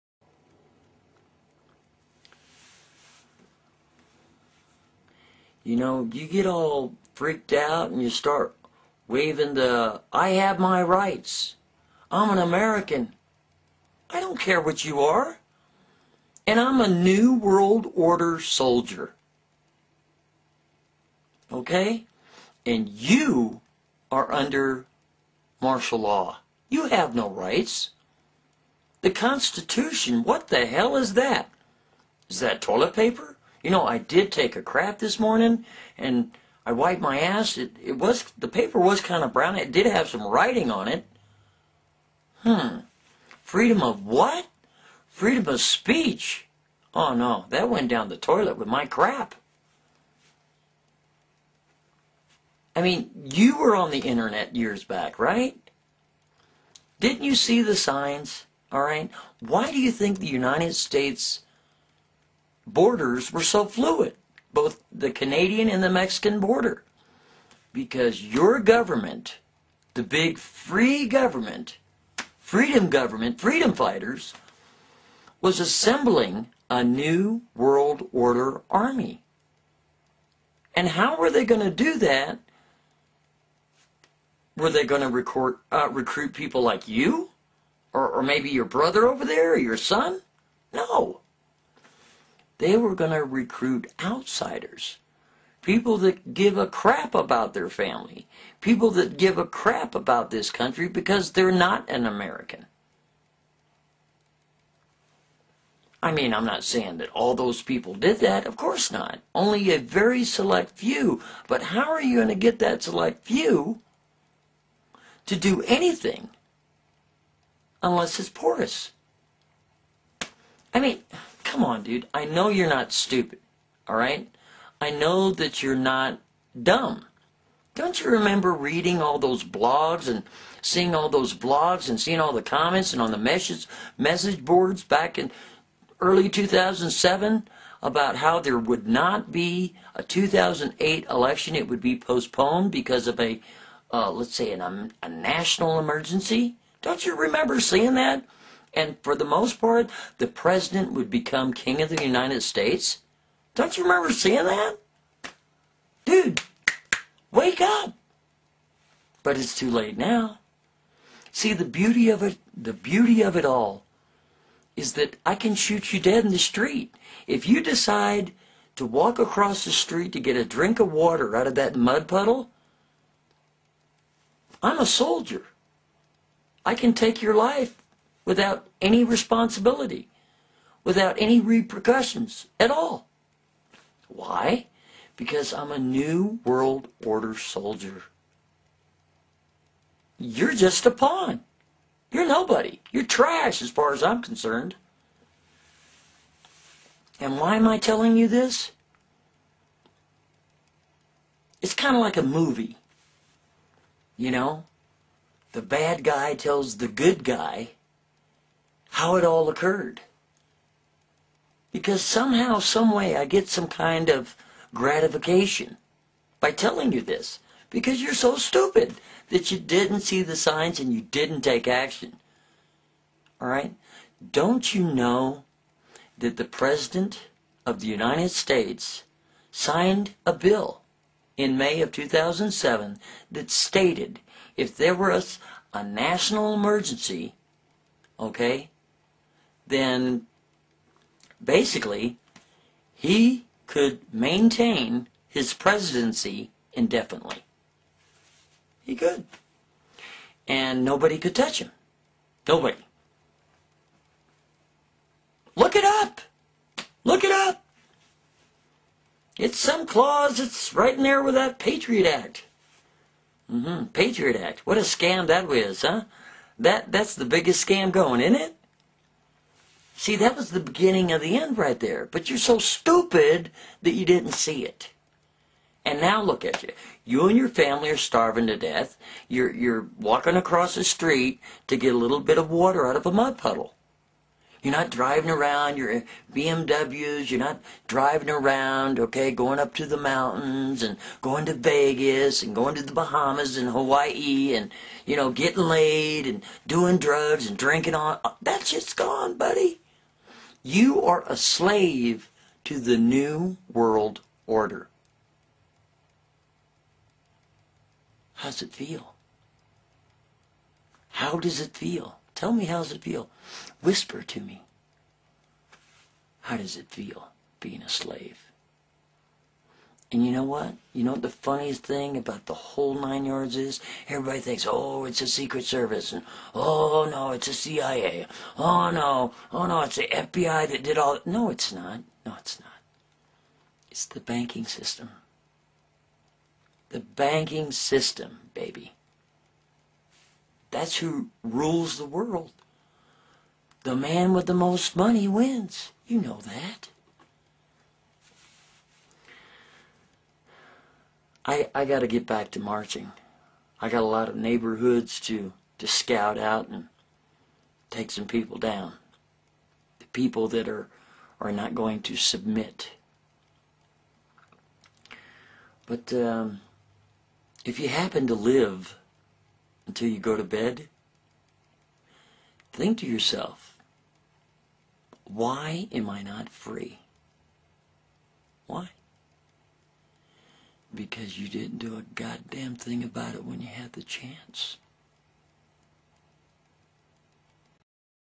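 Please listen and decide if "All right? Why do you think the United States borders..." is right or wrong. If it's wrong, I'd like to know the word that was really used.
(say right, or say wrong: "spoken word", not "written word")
right.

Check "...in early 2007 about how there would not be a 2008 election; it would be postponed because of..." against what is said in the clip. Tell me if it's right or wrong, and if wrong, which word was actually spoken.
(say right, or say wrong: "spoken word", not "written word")
right.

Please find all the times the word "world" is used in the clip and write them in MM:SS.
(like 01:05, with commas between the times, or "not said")
00:17, 01:17, 03:06, 05:03, 05:42.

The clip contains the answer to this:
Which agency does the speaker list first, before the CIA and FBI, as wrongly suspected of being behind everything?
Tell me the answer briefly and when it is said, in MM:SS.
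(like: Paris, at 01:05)
Secret Service, at 05:25.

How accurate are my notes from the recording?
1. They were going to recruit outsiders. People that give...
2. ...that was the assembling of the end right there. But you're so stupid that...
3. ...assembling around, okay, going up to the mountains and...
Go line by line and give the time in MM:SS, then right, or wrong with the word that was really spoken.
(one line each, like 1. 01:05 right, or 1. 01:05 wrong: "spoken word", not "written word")
1. 01:32 right
2. 04:30 wrong: "beginning", not "assembling"
3. 04:47 wrong: "driving", not "assembling".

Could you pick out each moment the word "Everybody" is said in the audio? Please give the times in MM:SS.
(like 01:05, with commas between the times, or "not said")
05:24.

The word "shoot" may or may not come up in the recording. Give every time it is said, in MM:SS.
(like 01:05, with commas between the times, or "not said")
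02:45.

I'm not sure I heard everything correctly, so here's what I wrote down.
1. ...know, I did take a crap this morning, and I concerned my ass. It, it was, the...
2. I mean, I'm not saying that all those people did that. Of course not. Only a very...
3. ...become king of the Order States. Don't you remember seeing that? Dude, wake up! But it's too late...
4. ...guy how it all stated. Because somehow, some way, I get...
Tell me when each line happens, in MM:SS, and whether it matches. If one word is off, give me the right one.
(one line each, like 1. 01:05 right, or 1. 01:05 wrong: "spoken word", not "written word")
1. 00:33 wrong: "wiped", not "concerned"
2. 01:46 right
3. 02:31 wrong: "United", not "Order"
4. 03:27 wrong: "occurred", not "stated".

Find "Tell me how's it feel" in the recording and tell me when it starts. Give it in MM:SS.
05:12.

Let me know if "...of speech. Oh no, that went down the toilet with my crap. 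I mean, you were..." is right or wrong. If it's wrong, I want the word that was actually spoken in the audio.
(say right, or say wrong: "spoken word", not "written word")
right.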